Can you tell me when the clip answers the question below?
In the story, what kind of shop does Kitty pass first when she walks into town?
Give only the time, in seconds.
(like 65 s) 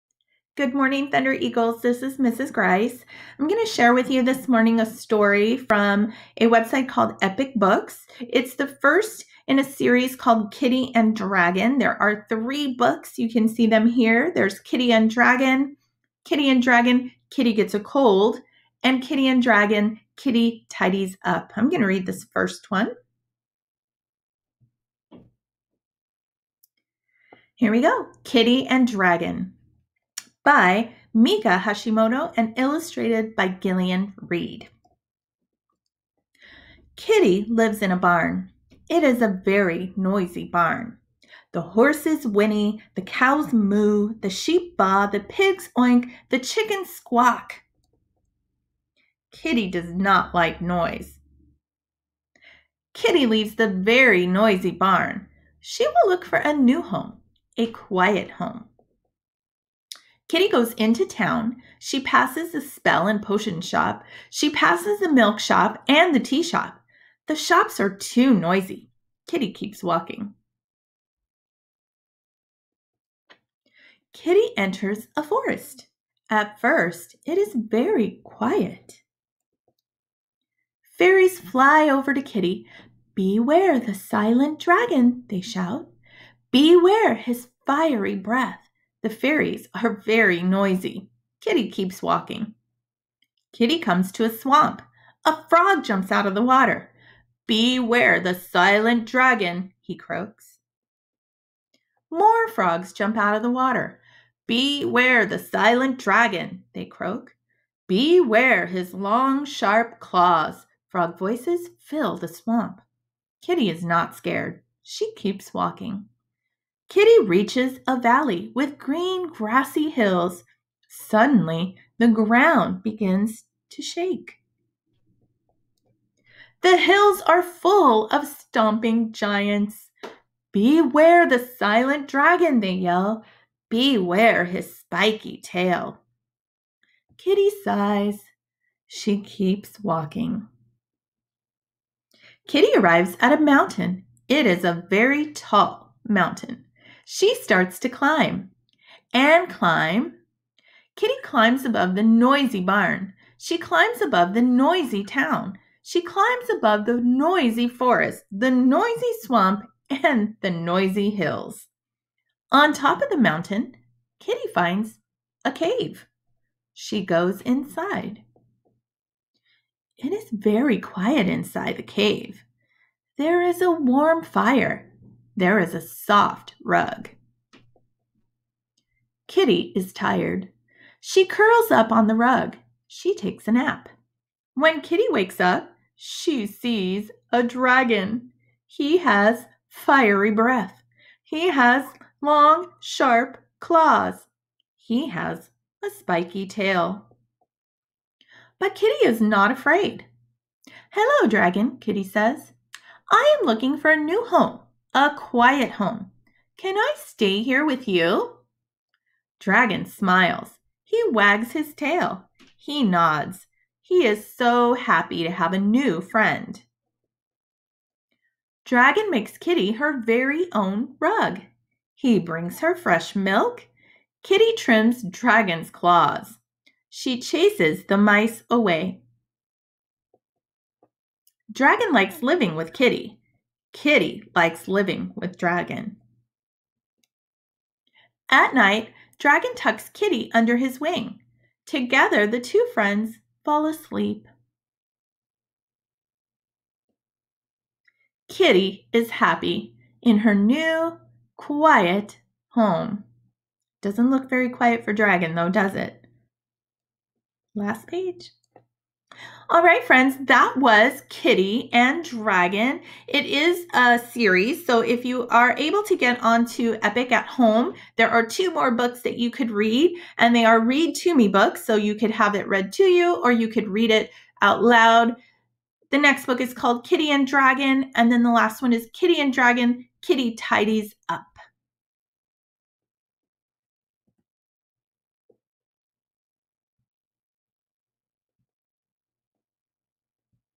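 62 s.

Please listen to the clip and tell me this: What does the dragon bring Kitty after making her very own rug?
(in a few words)
Fresh milk.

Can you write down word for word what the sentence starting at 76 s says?
At first, it is very quiet.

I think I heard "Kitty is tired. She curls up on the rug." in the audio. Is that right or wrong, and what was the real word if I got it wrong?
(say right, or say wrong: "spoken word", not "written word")
right.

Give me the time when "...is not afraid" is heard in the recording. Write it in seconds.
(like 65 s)
199 s.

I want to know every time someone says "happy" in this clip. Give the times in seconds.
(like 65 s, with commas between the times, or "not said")
214 s, 249 s.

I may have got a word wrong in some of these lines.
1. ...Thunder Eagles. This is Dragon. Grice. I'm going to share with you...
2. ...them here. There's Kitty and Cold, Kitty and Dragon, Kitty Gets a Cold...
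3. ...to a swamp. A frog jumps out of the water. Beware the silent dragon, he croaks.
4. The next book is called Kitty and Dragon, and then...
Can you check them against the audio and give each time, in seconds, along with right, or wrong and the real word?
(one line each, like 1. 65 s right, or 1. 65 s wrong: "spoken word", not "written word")
1. 1 s wrong: "Mrs", not "Dragon"
2. 13 s wrong: "Dragon", not "Cold"
3. 94 s right
4. 275 s right.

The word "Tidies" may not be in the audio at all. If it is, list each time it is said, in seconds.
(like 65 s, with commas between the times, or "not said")
20 s, 280 s.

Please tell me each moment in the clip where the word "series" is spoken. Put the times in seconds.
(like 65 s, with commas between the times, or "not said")
9 s, 263 s.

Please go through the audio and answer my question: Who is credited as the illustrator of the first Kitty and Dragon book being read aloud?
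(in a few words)
Gillian Reid.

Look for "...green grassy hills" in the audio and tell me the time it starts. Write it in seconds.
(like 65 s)
118 s.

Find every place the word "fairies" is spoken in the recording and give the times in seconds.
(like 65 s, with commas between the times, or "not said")
80 s, 89 s.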